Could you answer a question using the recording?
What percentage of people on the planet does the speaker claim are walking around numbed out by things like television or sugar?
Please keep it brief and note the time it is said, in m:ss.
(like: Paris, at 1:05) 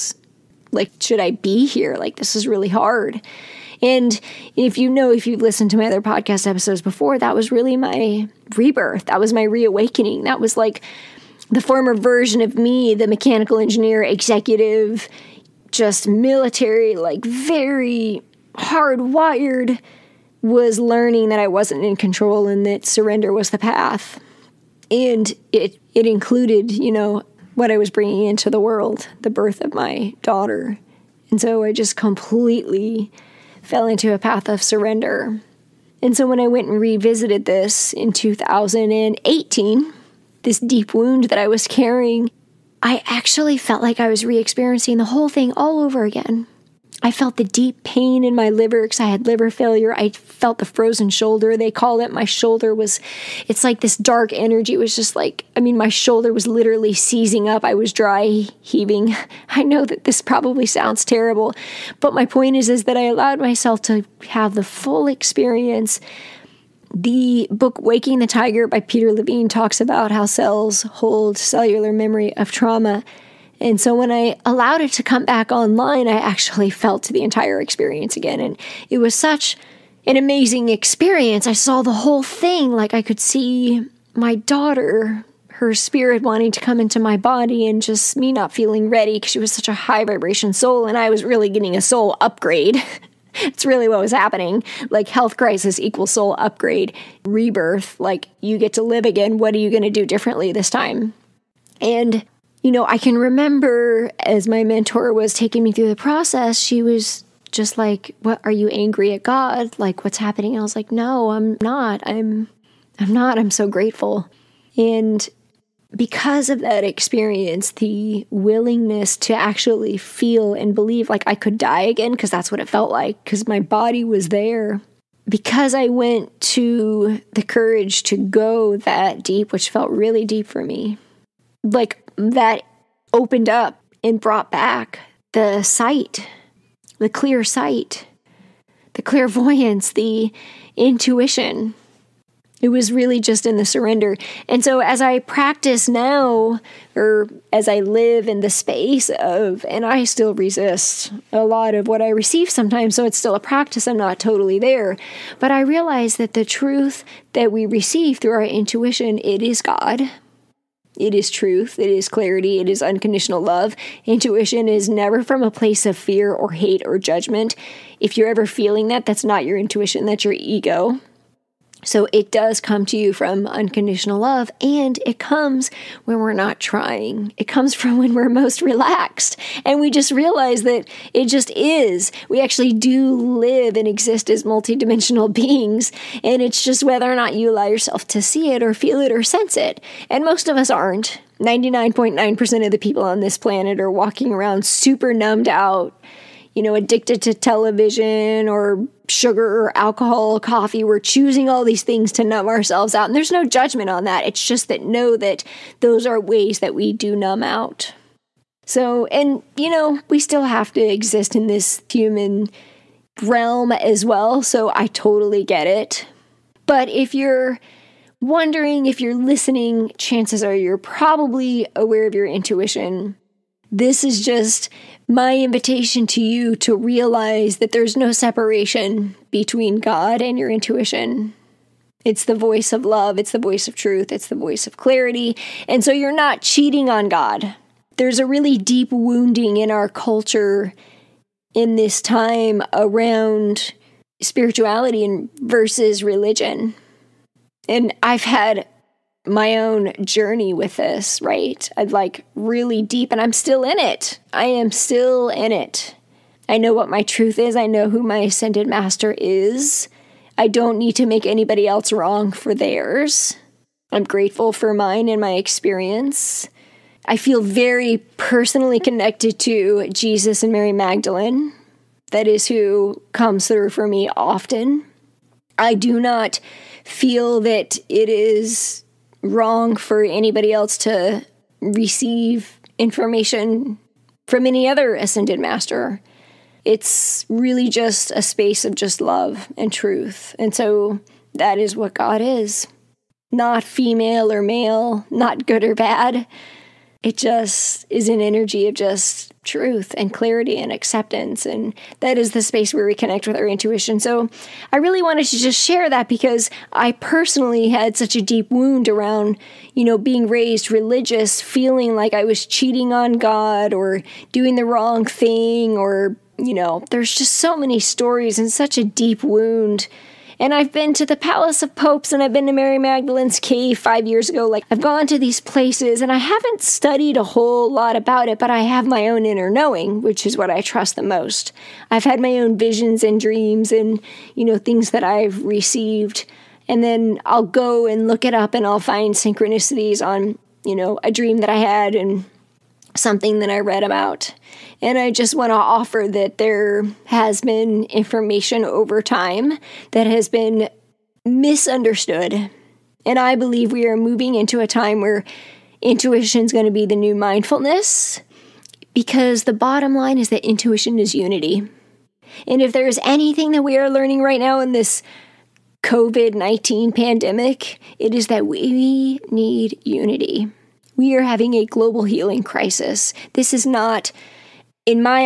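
99.9%, at 3:11.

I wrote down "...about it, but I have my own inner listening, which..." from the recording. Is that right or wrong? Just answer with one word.
wrong.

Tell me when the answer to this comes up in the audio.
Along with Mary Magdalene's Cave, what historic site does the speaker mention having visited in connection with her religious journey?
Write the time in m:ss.
5:21.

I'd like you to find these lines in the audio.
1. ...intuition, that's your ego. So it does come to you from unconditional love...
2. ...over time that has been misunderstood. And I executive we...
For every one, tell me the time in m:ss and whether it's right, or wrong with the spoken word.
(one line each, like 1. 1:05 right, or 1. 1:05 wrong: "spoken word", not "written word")
1. 2:49 right
2. 5:48 wrong: "believe", not "executive".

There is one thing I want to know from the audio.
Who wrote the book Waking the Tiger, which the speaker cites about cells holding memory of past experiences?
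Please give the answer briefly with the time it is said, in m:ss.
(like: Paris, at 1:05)
Peter Levine, at 1:08.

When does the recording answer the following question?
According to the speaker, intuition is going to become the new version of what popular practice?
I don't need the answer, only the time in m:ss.
5:57.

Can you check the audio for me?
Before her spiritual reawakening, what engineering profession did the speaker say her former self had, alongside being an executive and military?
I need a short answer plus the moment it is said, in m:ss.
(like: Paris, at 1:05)
Mechanical engineer, at 0:13.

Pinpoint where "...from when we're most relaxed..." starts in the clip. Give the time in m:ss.
2:57.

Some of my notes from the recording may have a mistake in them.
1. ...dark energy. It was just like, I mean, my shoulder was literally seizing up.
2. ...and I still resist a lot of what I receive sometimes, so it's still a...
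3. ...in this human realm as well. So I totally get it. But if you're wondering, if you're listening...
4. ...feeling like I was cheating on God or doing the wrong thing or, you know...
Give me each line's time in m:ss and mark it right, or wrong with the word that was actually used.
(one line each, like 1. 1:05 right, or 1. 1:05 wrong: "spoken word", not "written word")
1. 0:53 right
2. 2:29 right
3. 3:31 right
4. 5:11 right.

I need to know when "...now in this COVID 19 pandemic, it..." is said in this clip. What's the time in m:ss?
6:04.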